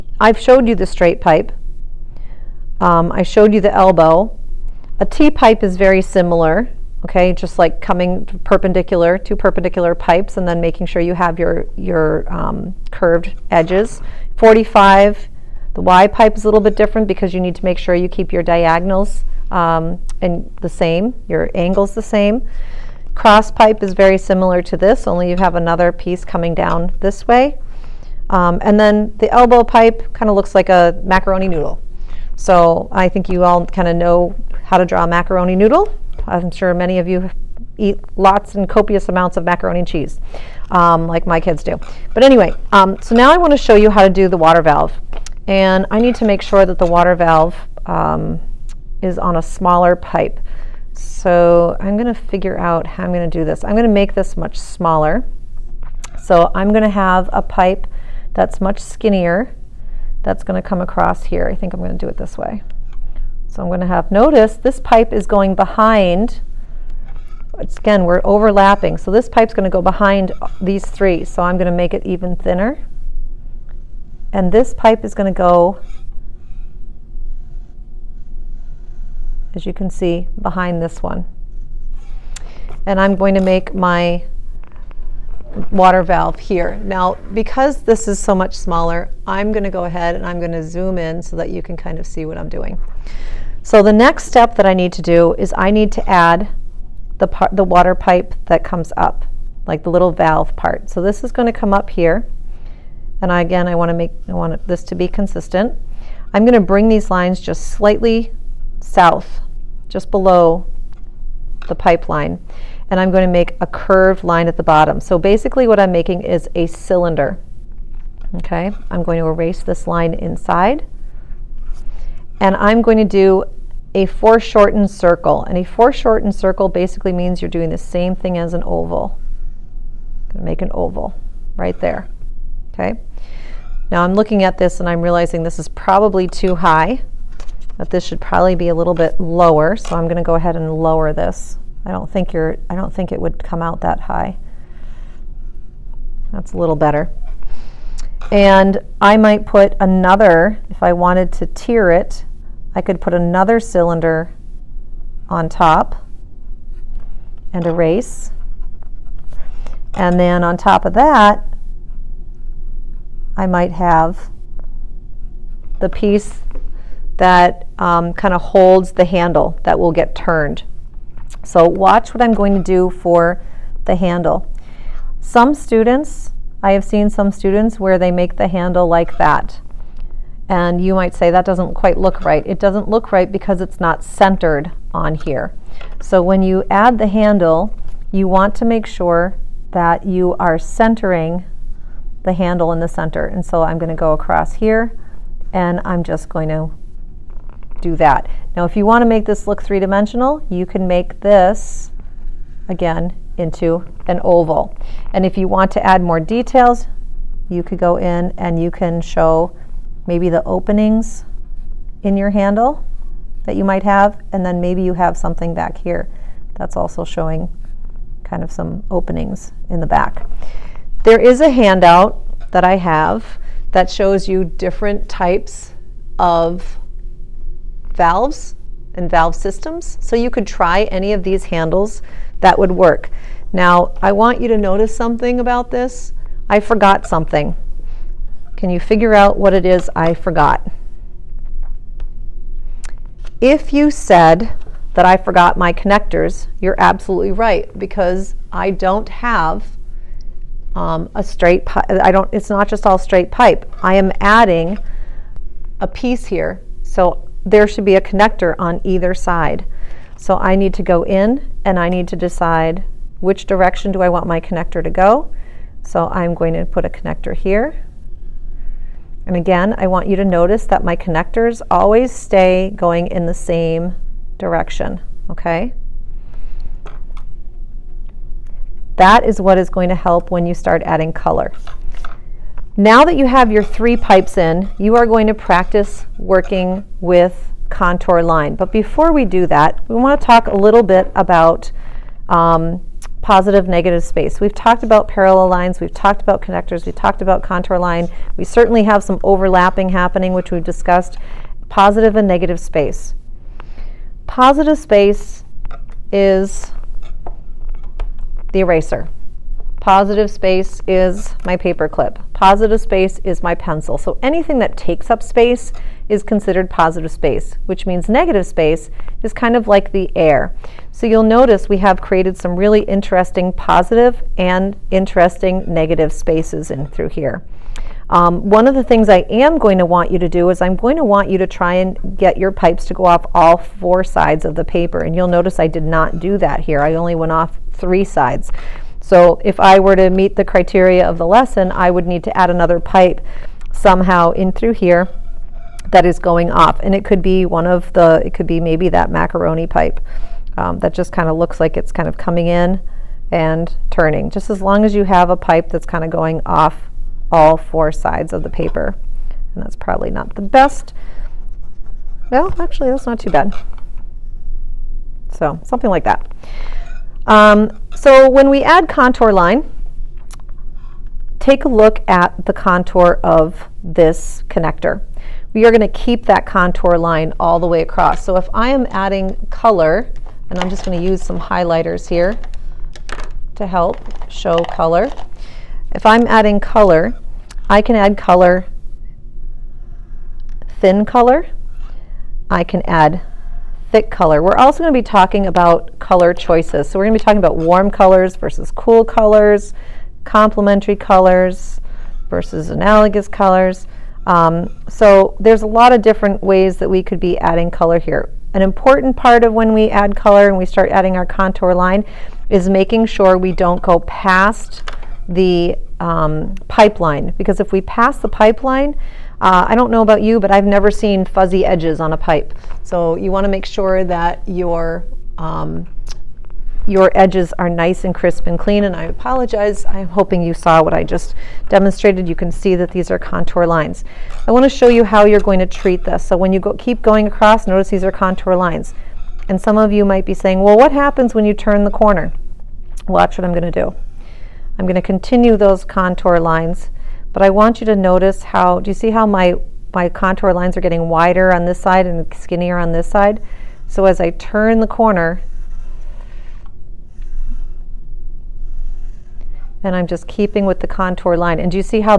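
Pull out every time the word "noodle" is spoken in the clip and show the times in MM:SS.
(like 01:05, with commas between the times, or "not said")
00:31, 00:35.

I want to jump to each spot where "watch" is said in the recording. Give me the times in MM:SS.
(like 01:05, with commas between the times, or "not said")
02:51, 07:23.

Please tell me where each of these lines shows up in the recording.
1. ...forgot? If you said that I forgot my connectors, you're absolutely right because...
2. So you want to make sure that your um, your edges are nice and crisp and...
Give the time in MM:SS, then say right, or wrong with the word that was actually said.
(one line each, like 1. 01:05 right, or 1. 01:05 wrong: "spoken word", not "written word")
1. 04:00 right
2. 07:02 right.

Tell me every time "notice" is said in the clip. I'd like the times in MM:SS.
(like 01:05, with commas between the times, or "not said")
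01:04, 03:54, 04:30, 05:21, 05:35, 07:17, 07:27.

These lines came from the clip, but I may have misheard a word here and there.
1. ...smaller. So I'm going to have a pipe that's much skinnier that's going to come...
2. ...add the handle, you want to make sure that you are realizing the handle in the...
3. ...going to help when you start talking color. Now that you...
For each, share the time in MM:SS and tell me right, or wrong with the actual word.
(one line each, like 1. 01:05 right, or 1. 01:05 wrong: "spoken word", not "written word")
1. 00:54 right
2. 03:06 wrong: "centering", not "realizing"
3. 04:39 wrong: "adding", not "talking".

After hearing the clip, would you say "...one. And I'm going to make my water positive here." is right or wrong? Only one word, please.
wrong.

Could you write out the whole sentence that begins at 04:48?
But before we do that, we want to talk a little bit about um, positive negative space.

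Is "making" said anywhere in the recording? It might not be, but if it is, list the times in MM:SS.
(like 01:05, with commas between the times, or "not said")
00:10, 01:55, 06:52.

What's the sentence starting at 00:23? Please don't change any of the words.
Cross pipe is very similar to this, only you have another piece coming down this way.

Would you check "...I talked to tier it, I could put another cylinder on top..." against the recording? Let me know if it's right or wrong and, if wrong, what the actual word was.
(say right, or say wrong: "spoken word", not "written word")
wrong: "wanted", not "talked".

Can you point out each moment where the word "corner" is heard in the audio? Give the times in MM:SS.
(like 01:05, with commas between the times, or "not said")
07:21, 07:34.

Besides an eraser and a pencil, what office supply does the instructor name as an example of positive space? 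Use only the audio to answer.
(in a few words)
Paper clip.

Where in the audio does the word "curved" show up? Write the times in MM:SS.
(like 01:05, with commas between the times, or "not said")
00:12, 01:53.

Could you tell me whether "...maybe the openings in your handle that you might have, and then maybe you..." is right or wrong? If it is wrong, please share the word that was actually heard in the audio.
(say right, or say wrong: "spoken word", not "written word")
right.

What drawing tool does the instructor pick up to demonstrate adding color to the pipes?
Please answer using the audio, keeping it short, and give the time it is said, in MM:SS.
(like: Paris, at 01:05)
Highlighters, at 06:21.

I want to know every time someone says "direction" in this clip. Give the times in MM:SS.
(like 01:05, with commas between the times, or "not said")
04:23, 04:34.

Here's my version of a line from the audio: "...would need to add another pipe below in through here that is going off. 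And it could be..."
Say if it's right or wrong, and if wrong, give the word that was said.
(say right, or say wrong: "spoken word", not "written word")
wrong: "somehow", not "below".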